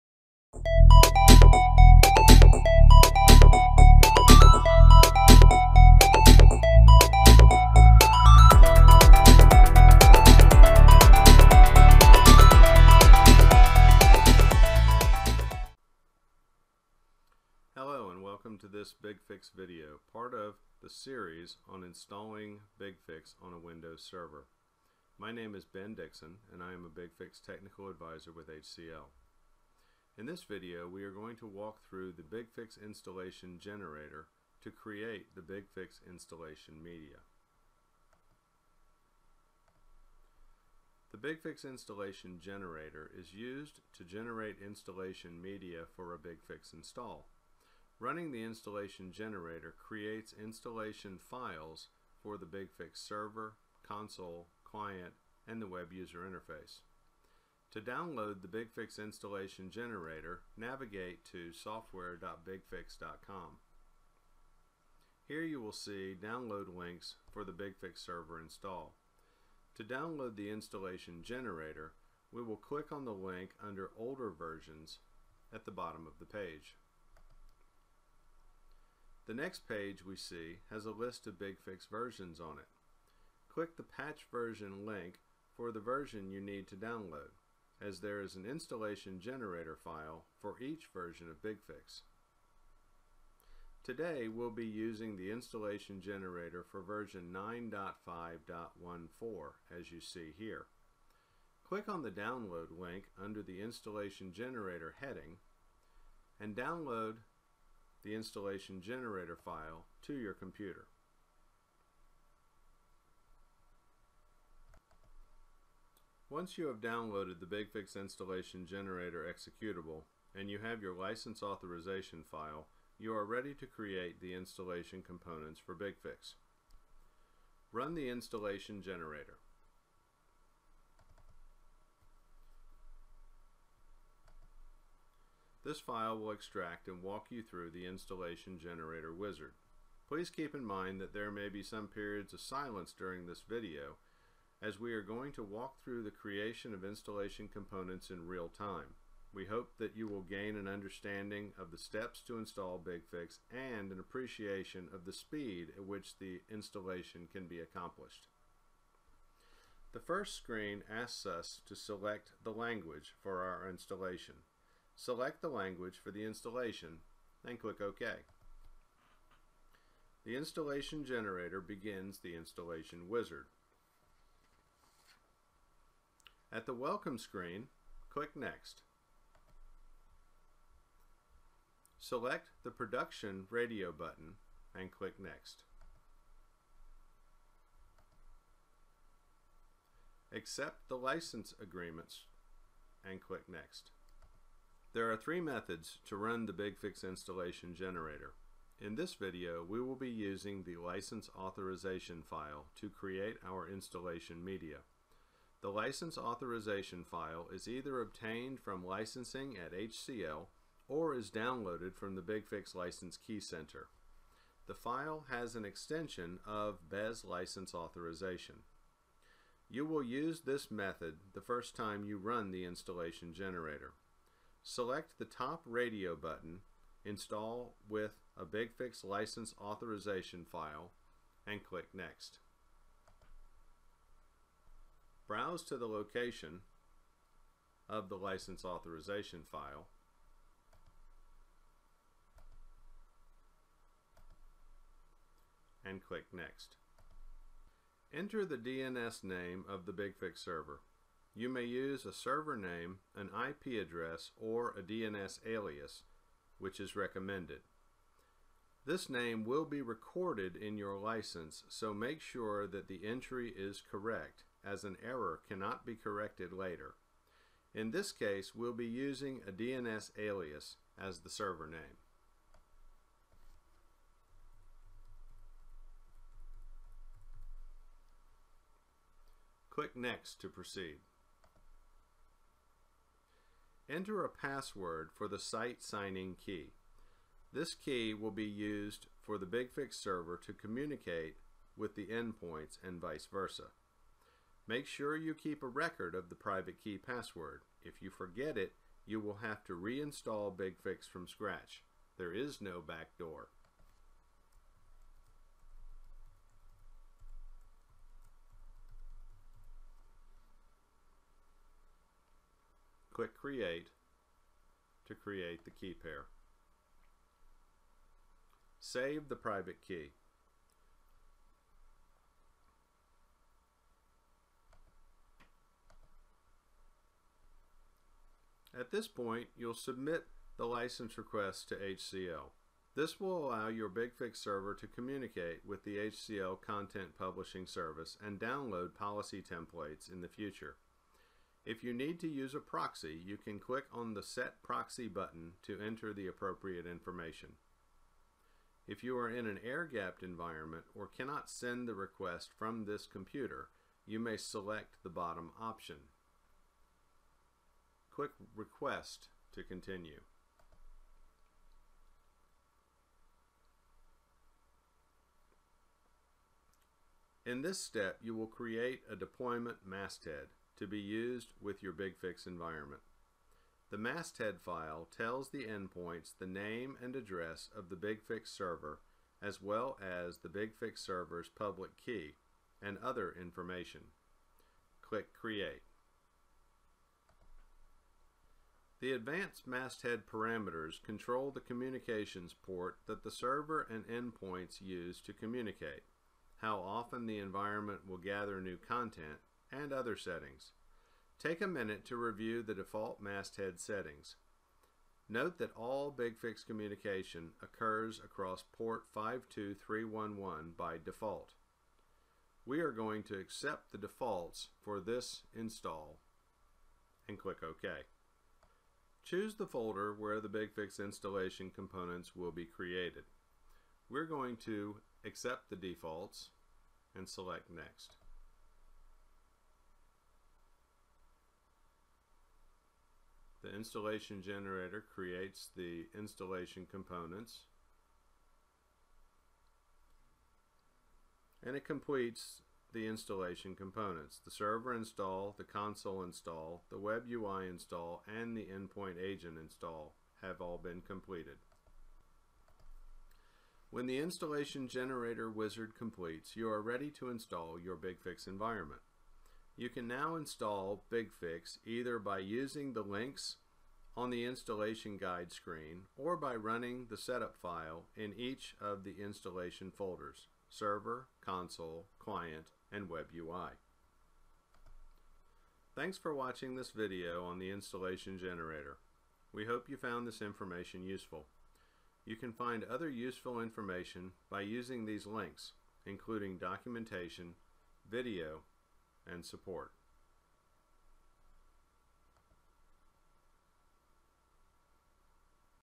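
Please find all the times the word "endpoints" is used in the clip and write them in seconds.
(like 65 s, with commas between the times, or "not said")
292 s, 375 s, 394 s, 448 s.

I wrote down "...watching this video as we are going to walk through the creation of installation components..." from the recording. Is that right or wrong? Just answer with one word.
wrong.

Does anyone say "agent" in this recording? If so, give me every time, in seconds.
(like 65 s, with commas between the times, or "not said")
449 s.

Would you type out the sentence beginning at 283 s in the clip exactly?
Enter a password for the site signing key.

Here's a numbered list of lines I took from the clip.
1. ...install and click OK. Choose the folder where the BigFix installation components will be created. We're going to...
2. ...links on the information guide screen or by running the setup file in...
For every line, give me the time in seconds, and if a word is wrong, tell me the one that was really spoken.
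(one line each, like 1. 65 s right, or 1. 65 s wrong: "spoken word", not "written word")
1. 415 s right
2. 463 s wrong: "installation", not "information".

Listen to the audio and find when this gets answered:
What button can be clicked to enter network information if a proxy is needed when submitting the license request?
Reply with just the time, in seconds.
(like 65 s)
344 s.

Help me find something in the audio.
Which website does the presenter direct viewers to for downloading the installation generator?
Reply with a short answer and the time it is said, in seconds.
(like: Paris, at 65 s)
software.bigfix.com, at 61 s.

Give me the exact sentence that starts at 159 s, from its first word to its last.
The first screen asks us to select the language for our installation.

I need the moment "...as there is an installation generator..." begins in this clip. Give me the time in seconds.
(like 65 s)
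87 s.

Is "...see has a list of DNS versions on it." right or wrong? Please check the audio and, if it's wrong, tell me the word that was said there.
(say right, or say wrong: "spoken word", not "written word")
wrong: "BigFix", not "DNS".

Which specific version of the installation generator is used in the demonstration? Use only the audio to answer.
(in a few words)
9.5.14.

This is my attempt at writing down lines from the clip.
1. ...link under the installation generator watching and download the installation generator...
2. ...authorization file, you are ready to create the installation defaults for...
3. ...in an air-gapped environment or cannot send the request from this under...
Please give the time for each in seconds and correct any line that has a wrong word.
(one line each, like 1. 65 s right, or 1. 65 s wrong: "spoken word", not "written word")
1. 102 s wrong: "heading", not "watching"
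2. 121 s wrong: "components", not "defaults"
3. 349 s wrong: "computer", not "under".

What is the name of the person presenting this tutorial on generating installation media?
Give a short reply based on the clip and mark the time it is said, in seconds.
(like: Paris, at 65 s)
Ben Dixon, at 25 s.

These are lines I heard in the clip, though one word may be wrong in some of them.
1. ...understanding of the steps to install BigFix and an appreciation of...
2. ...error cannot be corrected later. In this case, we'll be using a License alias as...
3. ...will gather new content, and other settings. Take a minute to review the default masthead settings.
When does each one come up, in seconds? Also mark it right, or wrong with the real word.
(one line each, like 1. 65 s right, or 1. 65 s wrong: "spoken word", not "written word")
1. 150 s right
2. 265 s wrong: "DNS", not "License"
3. 398 s right.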